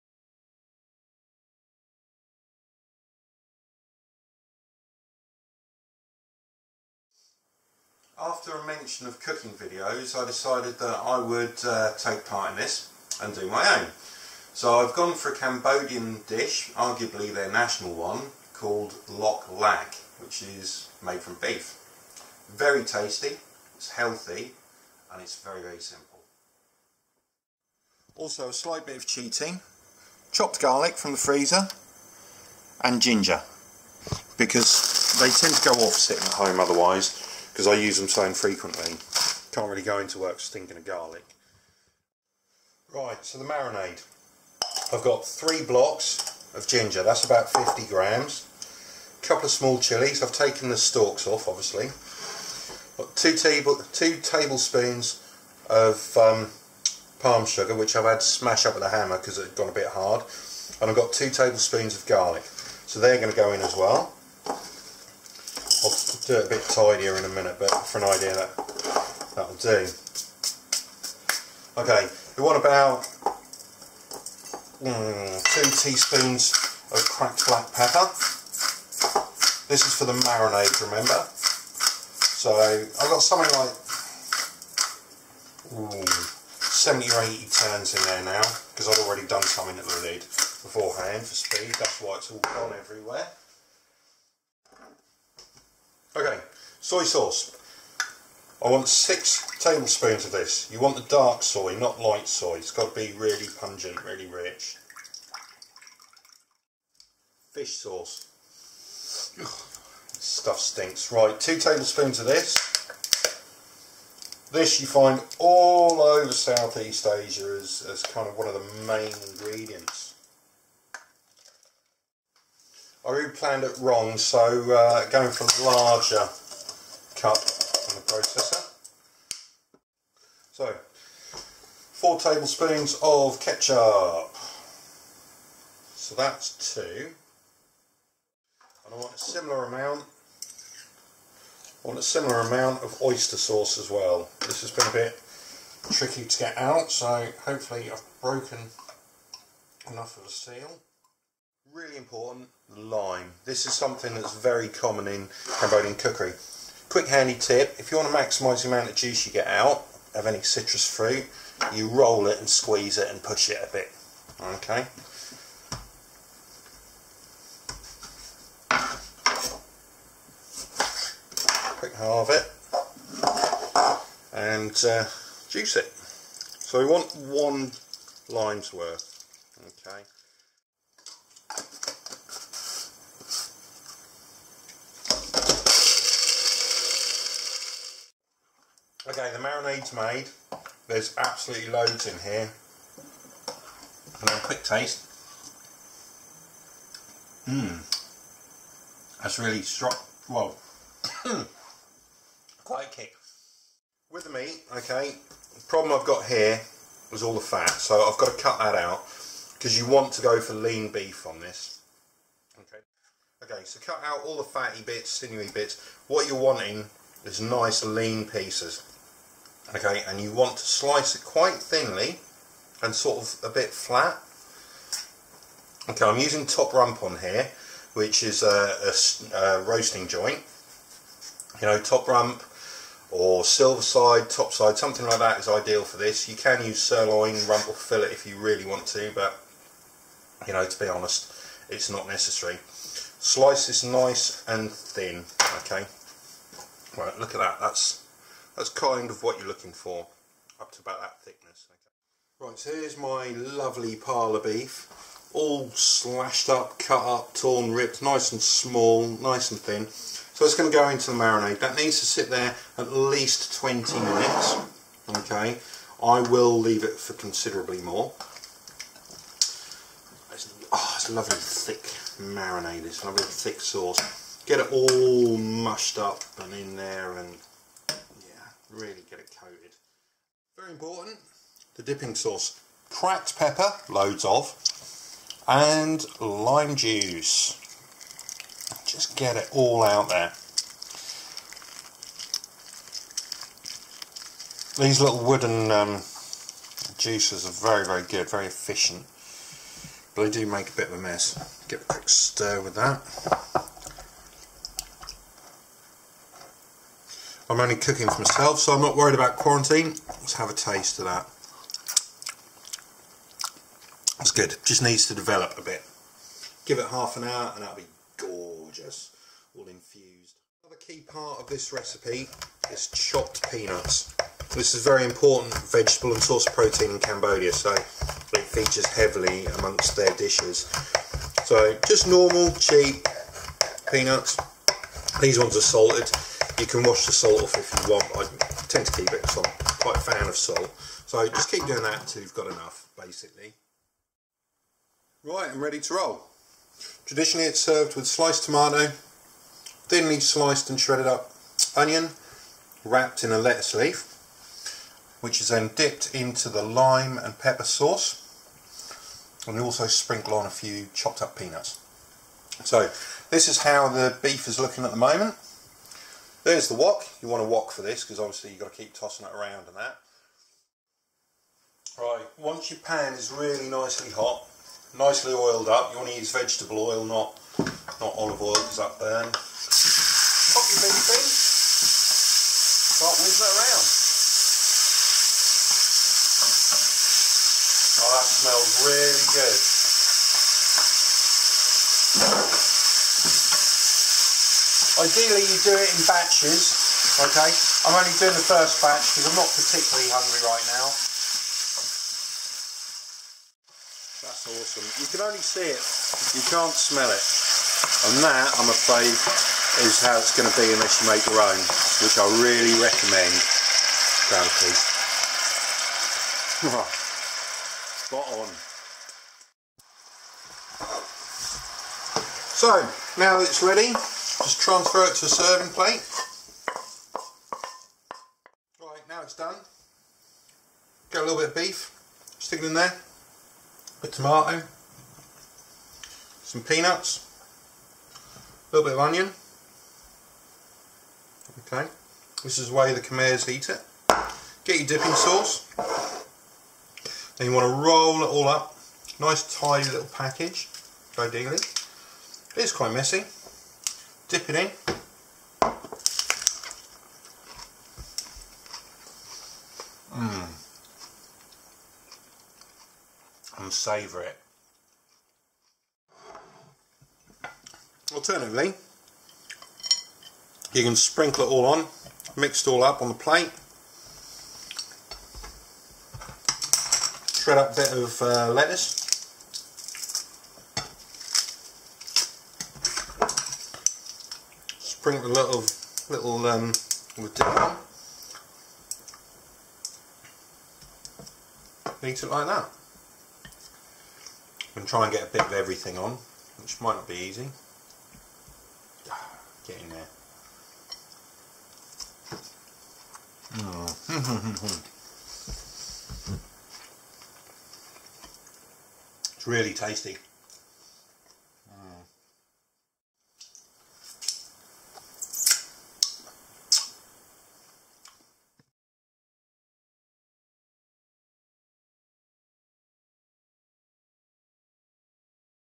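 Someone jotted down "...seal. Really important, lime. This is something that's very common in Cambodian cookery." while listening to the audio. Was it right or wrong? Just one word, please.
right.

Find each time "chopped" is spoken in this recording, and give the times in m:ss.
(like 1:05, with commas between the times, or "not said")
0:30, 5:22, 6:00.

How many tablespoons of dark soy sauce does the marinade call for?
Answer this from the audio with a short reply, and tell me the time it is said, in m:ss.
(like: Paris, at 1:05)
6, at 1:38.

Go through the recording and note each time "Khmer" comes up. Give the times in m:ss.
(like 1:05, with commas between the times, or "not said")
7:23.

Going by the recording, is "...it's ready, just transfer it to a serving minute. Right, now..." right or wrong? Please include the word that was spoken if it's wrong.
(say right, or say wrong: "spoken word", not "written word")
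wrong: "plate", not "minute".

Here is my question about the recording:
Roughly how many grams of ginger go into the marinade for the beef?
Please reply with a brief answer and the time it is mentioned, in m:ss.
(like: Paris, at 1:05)
50 grams, at 0:47.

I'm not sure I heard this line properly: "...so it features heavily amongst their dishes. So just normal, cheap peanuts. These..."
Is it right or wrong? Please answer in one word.
right.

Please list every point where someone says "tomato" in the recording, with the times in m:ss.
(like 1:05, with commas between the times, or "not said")
5:48, 7:14.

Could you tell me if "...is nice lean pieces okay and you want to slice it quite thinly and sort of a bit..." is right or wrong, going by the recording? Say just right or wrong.
right.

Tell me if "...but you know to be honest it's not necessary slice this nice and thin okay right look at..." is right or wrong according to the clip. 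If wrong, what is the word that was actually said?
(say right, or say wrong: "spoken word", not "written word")
right.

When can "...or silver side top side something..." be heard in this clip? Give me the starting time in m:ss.
3:53.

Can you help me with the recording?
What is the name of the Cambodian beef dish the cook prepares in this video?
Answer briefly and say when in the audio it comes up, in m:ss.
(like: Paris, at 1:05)
Loc Lac, at 0:19.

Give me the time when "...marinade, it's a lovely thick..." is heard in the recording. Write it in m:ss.
4:32.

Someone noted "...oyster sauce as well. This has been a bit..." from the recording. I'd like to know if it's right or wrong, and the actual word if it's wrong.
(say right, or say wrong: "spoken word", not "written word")
right.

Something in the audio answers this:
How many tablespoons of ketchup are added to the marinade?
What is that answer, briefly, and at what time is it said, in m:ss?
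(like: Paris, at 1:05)
4, at 2:11.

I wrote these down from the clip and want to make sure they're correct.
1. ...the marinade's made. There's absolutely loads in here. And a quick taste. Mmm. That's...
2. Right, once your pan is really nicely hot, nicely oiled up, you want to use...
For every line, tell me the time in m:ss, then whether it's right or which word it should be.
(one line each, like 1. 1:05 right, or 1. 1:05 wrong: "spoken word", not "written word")
1. 3:09 right
2. 6:11 right.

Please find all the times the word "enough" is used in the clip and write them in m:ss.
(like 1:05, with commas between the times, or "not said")
2:29, 5:42.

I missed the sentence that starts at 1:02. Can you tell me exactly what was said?
So they're going to go in as well.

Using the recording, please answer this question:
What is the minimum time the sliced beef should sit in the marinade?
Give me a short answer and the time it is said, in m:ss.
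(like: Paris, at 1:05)
20 minutes, at 4:22.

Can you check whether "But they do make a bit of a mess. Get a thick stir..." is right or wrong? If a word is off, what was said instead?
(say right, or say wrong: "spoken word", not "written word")
wrong: "quick", not "thick".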